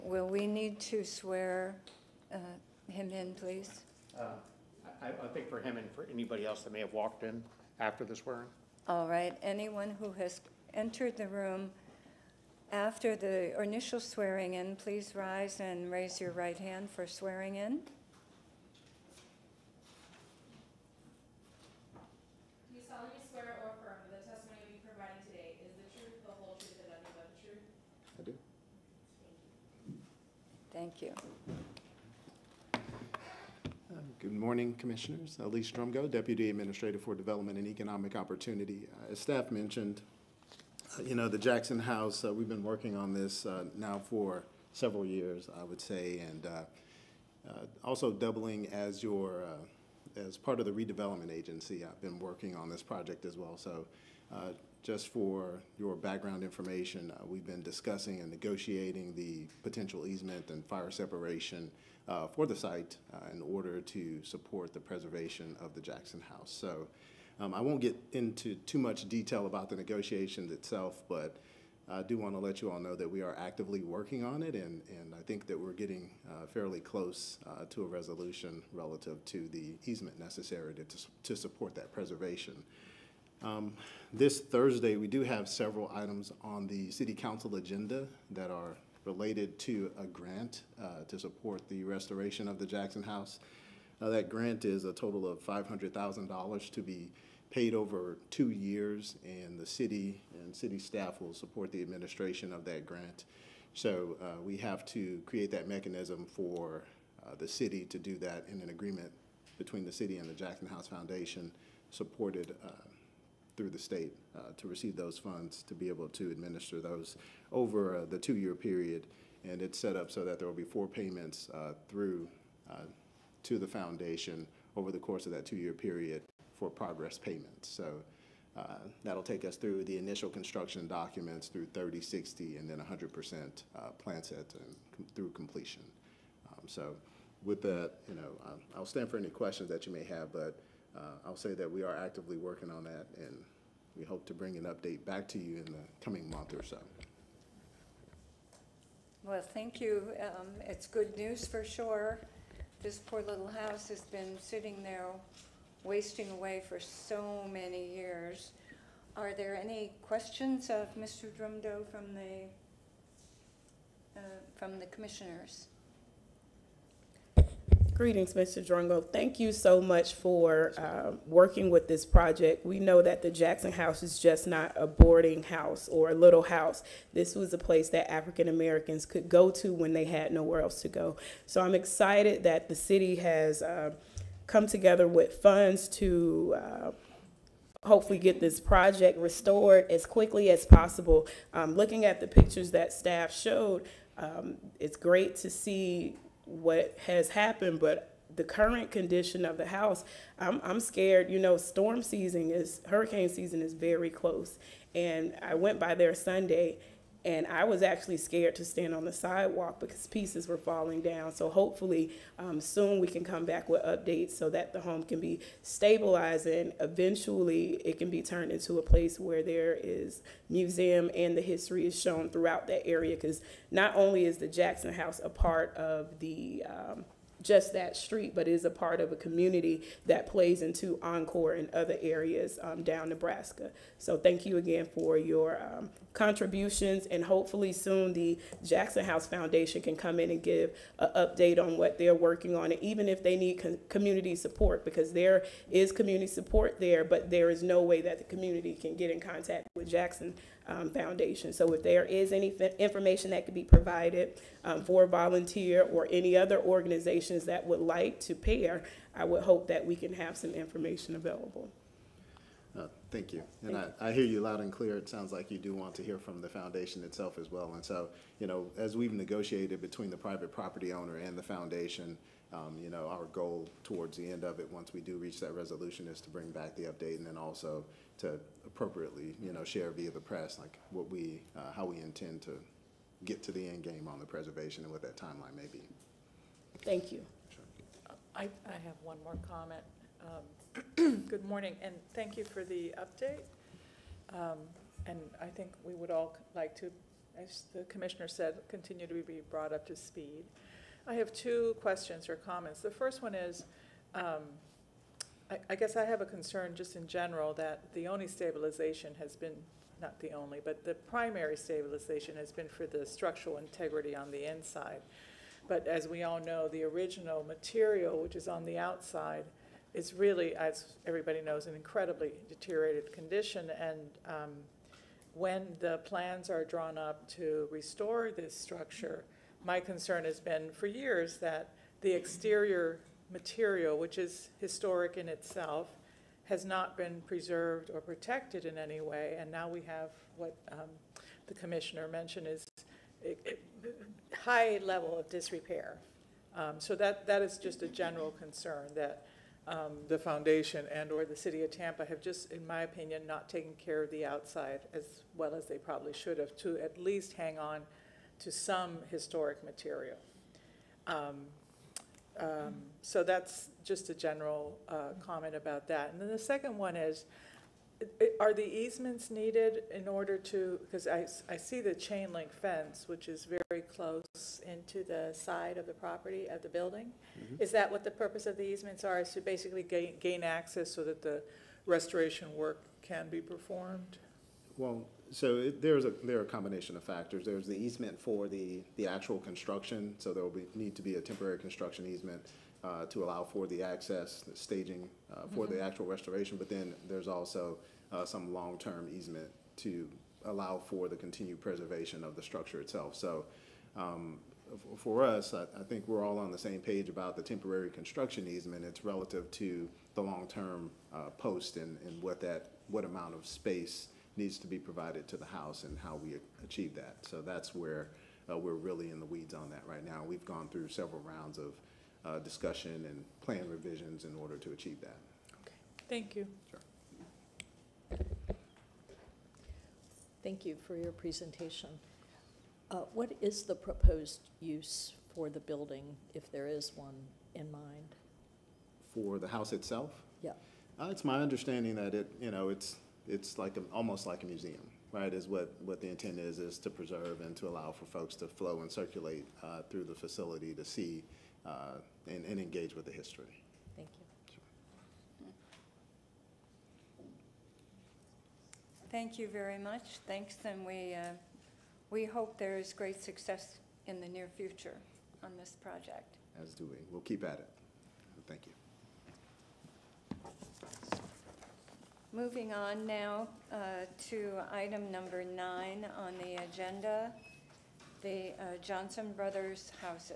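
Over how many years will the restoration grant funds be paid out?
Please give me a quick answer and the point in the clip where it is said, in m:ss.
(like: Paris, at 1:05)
2, at 1:38.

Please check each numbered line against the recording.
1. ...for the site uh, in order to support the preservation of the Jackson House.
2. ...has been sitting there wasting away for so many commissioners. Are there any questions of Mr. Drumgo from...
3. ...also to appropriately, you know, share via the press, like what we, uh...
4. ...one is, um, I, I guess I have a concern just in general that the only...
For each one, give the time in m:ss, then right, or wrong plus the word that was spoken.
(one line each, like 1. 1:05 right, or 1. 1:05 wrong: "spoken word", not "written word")
1. 1:02 right
2. 2:33 wrong: "years", not "commissioners"
3. 4:37 right
4. 5:03 right.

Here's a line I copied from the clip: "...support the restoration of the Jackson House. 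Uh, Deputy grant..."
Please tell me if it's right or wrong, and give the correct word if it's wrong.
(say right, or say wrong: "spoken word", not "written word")
wrong: "That", not "Deputy".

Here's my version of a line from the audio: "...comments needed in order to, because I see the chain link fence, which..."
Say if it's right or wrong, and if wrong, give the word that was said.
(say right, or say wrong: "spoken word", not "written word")
wrong: "easements", not "comments".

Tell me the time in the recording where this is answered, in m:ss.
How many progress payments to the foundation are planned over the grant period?
2:00.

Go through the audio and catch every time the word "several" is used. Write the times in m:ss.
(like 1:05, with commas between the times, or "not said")
0:44, 1:25, 7:00.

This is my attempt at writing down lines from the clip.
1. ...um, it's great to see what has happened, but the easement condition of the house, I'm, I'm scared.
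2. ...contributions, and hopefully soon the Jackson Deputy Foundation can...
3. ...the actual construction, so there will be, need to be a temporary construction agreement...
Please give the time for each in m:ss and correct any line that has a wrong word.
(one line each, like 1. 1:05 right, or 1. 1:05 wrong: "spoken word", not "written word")
1. 3:14 wrong: "current", not "easement"
2. 3:56 wrong: "House", not "Deputy"
3. 6:28 wrong: "easement", not "agreement".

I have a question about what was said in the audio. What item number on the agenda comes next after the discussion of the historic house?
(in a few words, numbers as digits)
9.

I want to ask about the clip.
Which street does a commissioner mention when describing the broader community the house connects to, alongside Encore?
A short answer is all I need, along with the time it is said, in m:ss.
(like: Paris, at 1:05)
Nebraska, at 3:53.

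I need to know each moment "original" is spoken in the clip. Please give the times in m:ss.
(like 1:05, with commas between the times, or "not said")
5:16.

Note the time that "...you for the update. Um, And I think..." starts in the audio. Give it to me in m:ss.
4:52.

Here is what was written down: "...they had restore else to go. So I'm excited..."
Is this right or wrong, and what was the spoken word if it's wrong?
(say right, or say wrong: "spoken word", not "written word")
wrong: "nowhere", not "restore".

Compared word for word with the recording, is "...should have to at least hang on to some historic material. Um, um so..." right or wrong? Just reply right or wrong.
right.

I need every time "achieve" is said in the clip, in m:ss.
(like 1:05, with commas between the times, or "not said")
6:56, 7:04.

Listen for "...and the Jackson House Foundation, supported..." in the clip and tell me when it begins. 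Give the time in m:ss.
1:50.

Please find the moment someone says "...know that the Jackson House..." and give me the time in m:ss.
2:52.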